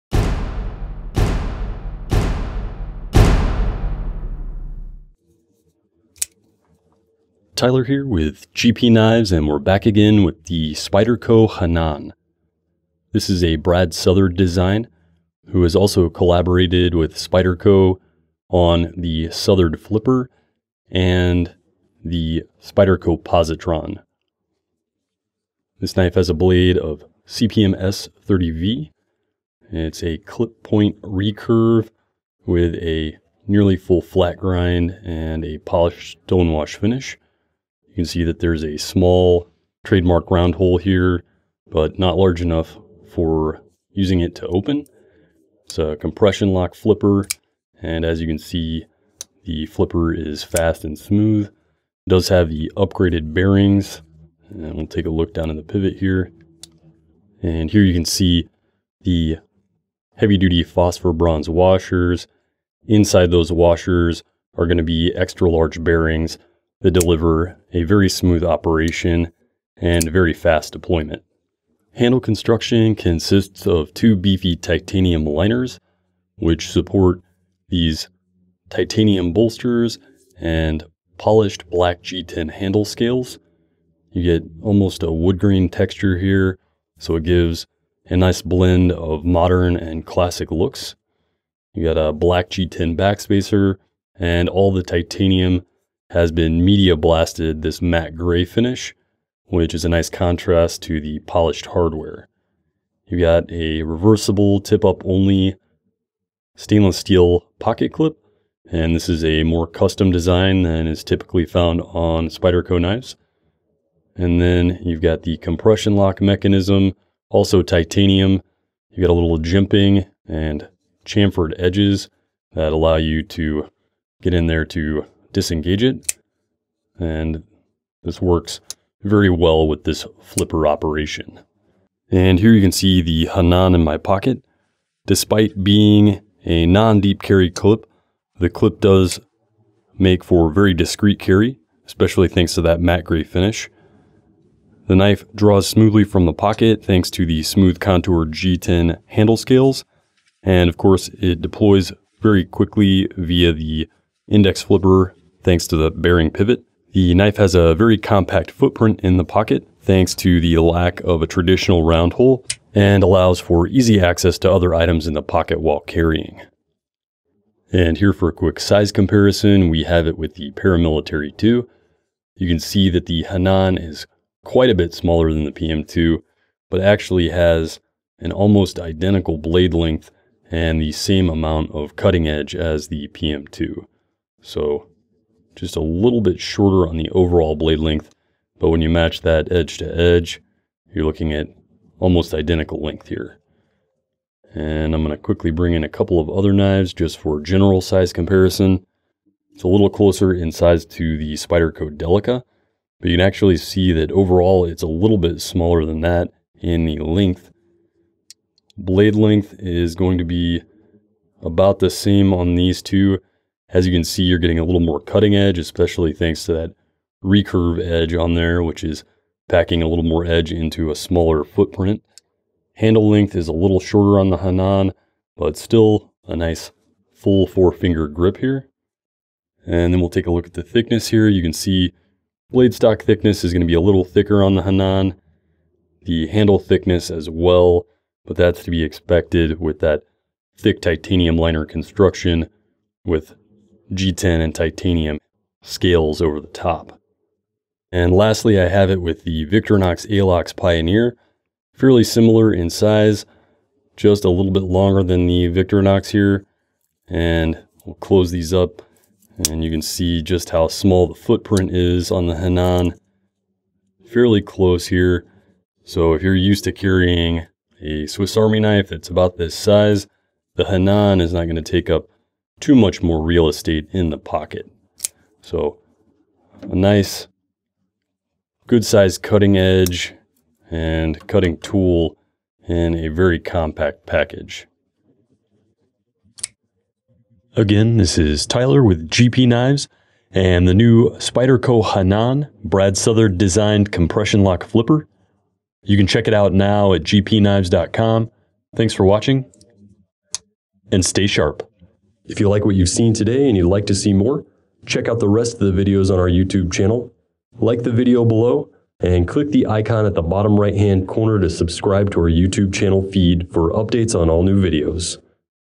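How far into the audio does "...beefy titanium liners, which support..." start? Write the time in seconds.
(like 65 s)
74 s.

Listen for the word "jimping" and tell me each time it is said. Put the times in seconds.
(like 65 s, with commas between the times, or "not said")
119 s.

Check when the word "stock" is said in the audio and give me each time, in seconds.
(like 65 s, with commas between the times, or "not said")
232 s.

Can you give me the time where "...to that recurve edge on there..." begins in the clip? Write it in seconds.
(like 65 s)
216 s.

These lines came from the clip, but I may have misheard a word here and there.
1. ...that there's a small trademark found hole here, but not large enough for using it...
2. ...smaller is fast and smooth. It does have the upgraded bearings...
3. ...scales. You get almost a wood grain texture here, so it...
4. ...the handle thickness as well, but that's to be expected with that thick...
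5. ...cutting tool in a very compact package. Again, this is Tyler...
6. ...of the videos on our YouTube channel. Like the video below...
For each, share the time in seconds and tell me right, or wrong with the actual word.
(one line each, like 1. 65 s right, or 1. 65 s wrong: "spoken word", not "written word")
1. 38 s wrong: "round", not "found"
2. 49 s wrong: "flipper", not "smaller"
3. 82 s right
4. 236 s right
5. 281 s right
6. 305 s right.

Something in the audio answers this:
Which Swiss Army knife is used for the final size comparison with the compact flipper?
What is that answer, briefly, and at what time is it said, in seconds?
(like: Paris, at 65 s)
Victorinox Alox Pioneer, at 249 s.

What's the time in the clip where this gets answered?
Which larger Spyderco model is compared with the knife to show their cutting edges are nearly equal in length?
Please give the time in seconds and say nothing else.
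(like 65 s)
170 s.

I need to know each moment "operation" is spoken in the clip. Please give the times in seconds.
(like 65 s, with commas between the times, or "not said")
68 s, 130 s.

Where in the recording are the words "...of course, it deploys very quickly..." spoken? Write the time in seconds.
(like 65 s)
150 s.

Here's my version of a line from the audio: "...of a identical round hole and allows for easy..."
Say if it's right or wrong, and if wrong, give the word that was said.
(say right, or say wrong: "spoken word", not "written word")
wrong: "traditional", not "identical".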